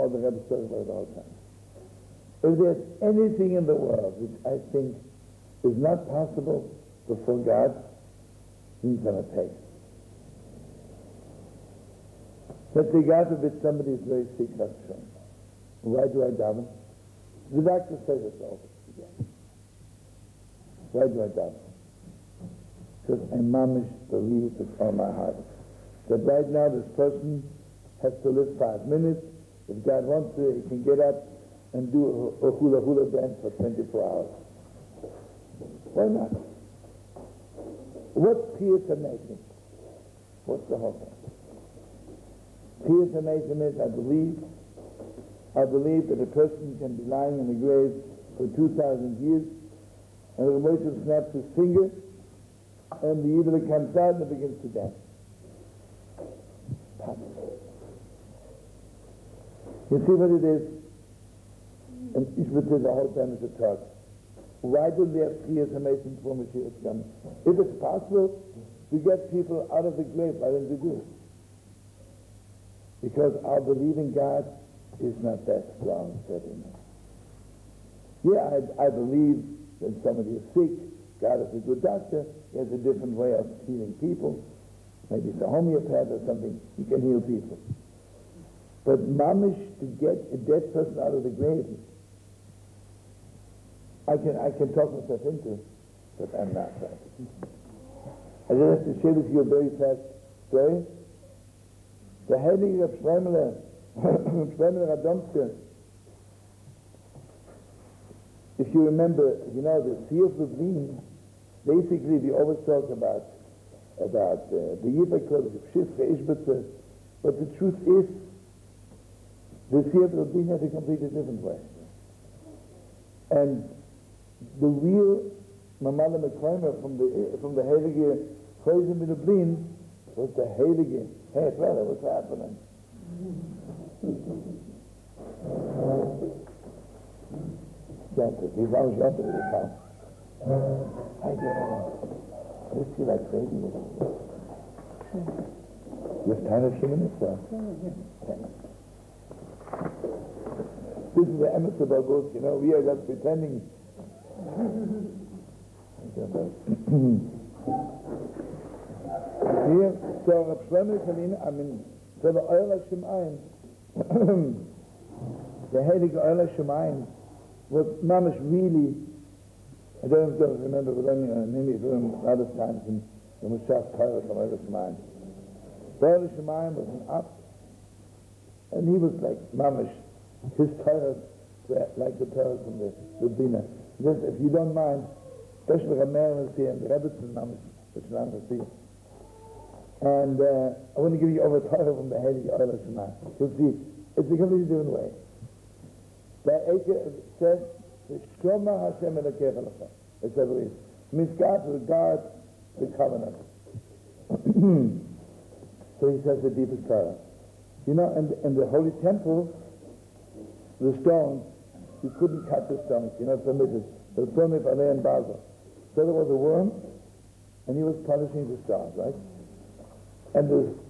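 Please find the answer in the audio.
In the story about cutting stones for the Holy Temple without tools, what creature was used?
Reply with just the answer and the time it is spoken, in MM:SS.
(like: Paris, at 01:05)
a worm, at 03:36.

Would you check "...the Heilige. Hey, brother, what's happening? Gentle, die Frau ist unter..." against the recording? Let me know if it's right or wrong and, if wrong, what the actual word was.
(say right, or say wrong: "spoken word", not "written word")
right.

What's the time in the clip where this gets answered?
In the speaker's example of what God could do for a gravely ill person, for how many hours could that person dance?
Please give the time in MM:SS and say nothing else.
00:33.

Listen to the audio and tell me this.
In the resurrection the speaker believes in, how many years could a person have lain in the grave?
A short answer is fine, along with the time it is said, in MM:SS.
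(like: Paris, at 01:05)
2,000, at 00:48.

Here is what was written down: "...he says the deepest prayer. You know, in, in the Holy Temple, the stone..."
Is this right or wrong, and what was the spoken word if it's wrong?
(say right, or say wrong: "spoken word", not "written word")
right.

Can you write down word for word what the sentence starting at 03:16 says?
The Eker says, Shoma Hashem Elokech it It's God misgod regard the covenant.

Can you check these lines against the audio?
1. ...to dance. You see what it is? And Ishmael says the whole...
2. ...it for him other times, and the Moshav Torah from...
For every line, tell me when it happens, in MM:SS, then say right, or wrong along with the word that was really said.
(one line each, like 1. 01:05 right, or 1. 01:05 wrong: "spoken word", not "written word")
1. 00:54 right
2. 02:51 right.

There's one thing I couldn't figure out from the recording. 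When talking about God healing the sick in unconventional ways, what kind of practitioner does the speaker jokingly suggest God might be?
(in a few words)
homeopath.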